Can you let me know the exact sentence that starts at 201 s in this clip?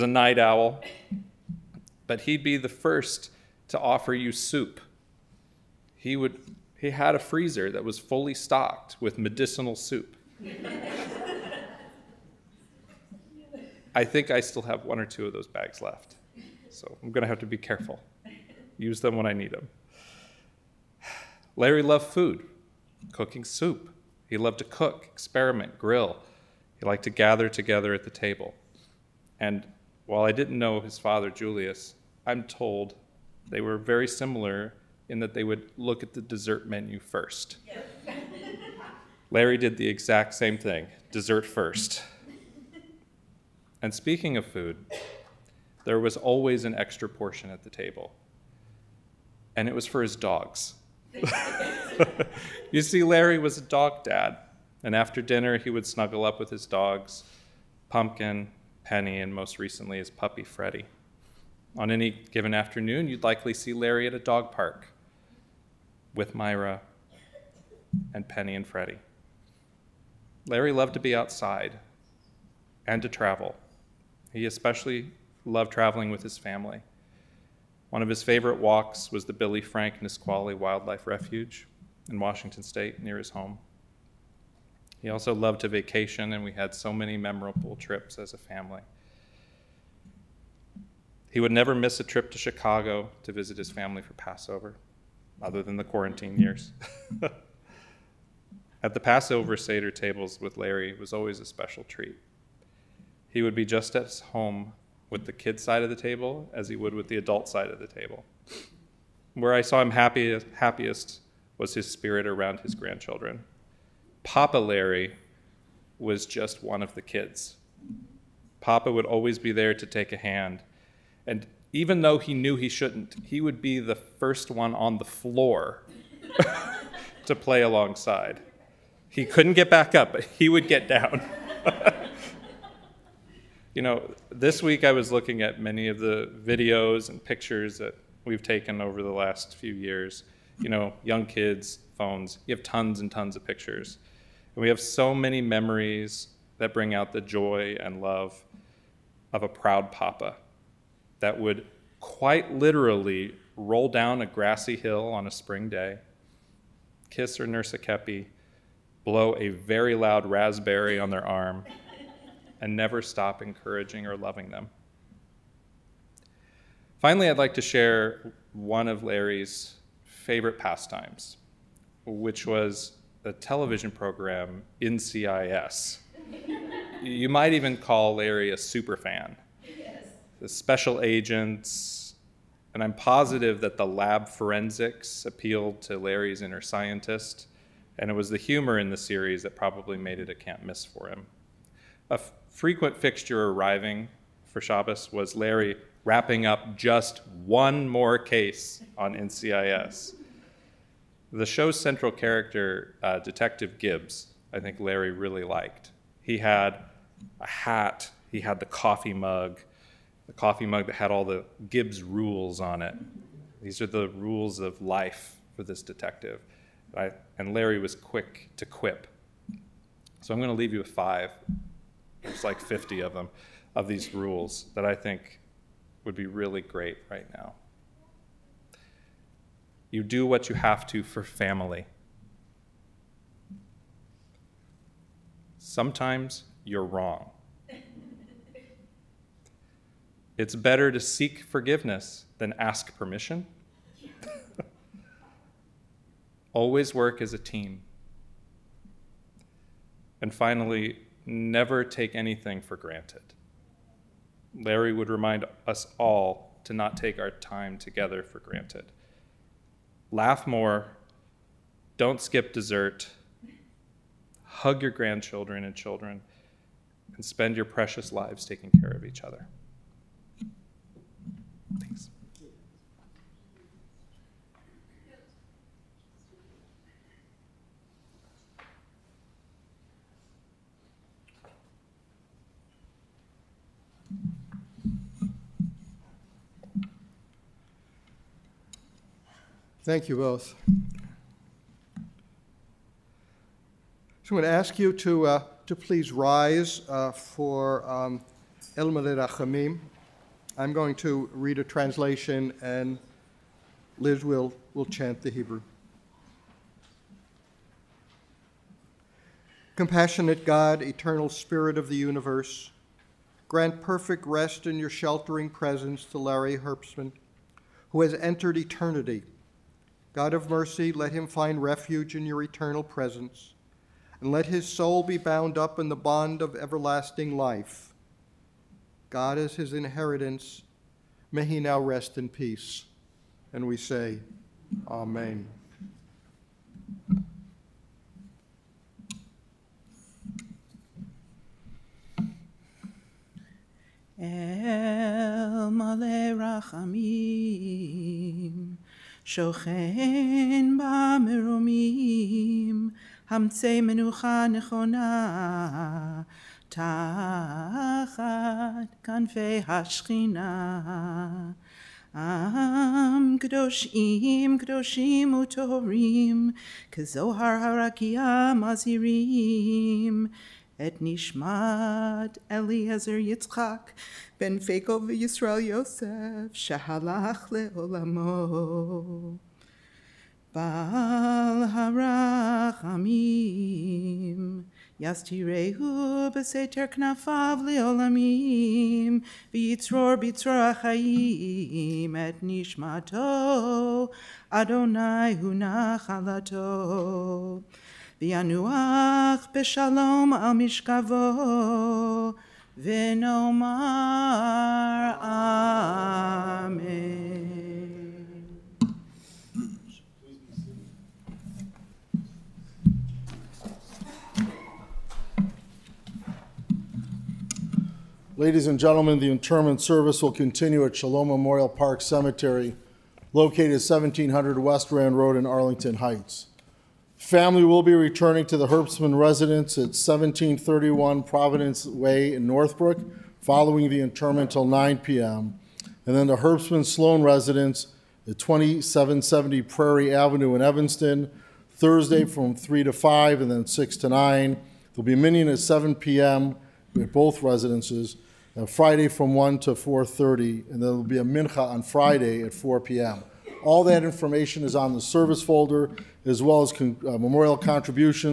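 The show's central character, uh, Detective Gibbs, I think Larry really liked.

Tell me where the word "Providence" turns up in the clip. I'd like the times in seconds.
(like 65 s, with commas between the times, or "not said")
431 s.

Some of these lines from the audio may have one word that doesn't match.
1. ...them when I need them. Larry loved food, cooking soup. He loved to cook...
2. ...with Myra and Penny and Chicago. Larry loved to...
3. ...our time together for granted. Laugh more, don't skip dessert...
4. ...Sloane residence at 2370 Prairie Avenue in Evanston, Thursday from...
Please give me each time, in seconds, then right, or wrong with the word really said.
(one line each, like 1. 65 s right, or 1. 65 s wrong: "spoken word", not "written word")
1. 18 s right
2. 66 s wrong: "Freddie", not "Chicago"
3. 257 s right
4. 436 s wrong: "2770", not "2370".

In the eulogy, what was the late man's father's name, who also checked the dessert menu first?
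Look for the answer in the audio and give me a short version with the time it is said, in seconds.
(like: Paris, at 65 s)
Julius, at 31 s.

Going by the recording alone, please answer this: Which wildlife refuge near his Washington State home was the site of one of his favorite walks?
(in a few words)
Billy Frank Nisqually Wildlife Refuge.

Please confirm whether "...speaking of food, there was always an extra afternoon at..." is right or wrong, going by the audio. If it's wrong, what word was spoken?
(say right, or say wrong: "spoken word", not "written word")
wrong: "portion", not "afternoon".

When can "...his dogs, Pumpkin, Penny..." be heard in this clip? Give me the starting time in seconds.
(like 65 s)
56 s.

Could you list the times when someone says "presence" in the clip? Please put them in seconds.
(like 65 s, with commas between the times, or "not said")
315 s, 322 s.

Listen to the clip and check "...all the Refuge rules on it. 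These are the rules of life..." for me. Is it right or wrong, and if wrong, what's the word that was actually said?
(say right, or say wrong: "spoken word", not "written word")
wrong: "Gibbs", not "Refuge".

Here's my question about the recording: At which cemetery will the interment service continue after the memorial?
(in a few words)
Shalom Memorial Park.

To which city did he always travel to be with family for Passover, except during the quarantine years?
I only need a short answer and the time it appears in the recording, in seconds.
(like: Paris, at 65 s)
Chicago, at 92 s.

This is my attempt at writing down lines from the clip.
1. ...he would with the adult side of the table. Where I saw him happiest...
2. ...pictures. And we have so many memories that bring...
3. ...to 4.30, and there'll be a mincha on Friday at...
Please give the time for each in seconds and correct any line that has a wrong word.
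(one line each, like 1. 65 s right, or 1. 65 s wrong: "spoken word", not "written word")
1. 106 s right
2. 143 s right
3. 449 s right.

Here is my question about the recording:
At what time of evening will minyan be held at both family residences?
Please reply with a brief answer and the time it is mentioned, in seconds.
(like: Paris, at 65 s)
7 p.m., at 445 s.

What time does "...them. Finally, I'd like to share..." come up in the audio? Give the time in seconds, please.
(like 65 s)
164 s.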